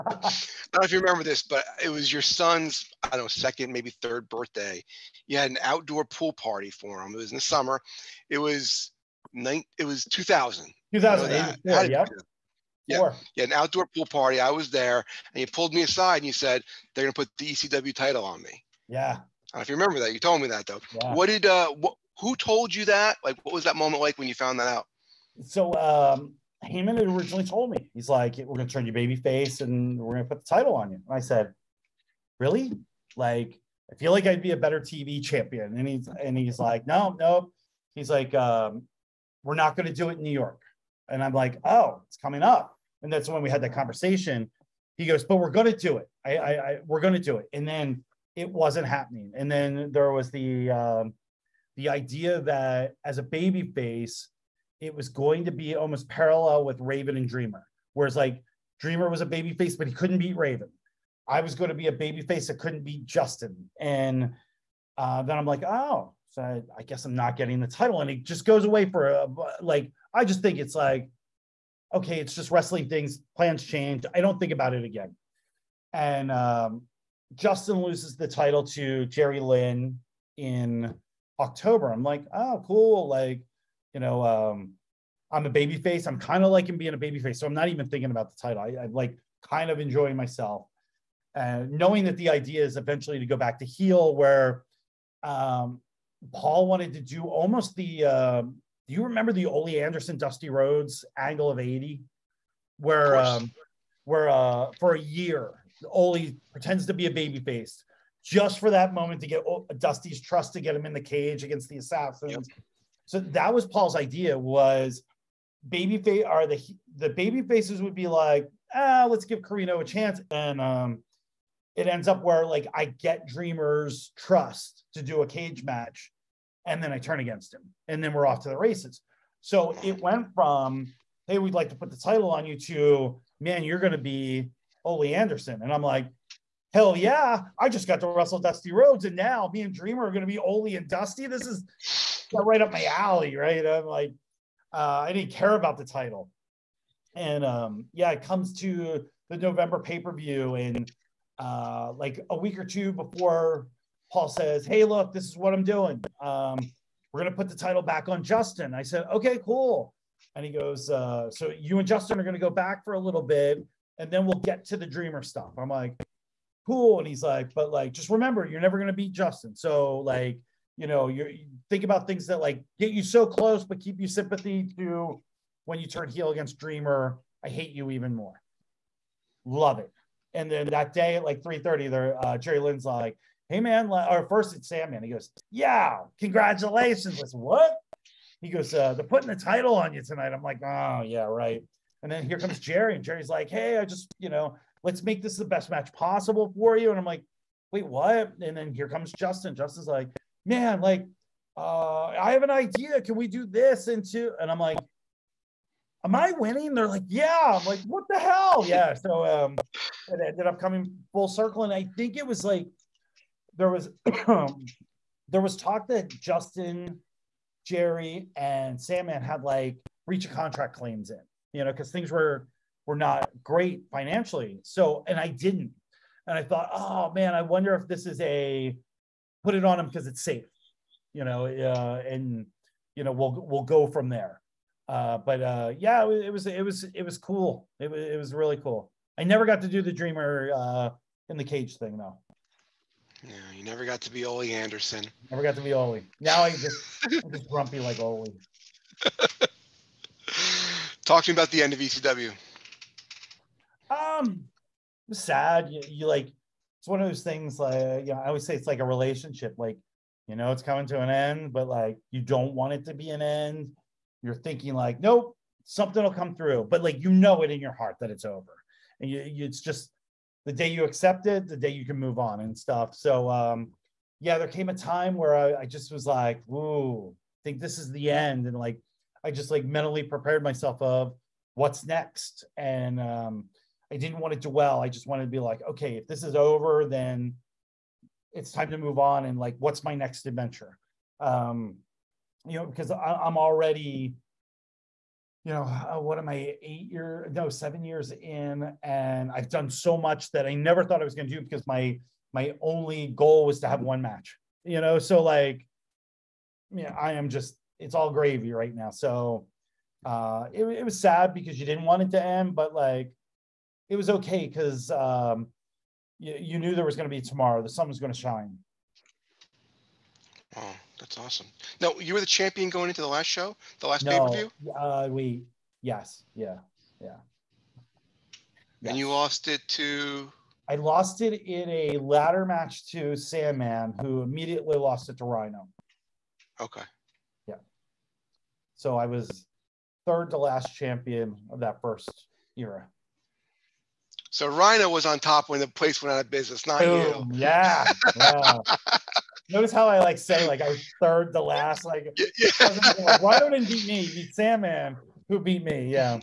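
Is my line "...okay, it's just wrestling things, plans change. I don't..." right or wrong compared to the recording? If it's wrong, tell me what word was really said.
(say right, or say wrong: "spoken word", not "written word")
right.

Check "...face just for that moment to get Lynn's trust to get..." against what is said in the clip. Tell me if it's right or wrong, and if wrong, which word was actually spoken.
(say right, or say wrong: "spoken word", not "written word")
wrong: "Dusty", not "Lynn".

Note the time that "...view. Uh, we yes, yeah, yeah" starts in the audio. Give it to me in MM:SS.
05:24.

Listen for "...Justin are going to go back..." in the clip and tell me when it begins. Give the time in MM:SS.
02:41.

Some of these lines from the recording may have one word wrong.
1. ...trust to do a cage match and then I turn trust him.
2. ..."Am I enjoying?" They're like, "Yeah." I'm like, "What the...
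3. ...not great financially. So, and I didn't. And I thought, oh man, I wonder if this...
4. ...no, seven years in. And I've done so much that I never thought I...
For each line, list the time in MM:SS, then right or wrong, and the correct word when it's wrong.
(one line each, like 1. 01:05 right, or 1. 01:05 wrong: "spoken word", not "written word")
1. 02:04 wrong: "against", not "trust"
2. 03:26 wrong: "winning", not "enjoying"
3. 03:42 right
4. 04:57 right.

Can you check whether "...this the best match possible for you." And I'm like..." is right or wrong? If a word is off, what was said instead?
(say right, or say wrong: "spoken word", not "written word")
right.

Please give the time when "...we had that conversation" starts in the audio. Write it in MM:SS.
00:43.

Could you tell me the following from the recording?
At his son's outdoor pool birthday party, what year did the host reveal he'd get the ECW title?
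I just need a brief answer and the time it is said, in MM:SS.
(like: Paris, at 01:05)
2008, at 00:10.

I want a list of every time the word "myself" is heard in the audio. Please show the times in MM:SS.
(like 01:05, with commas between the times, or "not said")
01:30, 04:40.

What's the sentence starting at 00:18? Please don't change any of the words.
Yeah, I don't know if you remember that.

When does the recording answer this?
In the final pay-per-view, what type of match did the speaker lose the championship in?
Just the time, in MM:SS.
05:31.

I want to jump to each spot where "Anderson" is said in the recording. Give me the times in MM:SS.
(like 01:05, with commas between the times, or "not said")
01:39, 02:15, 04:04.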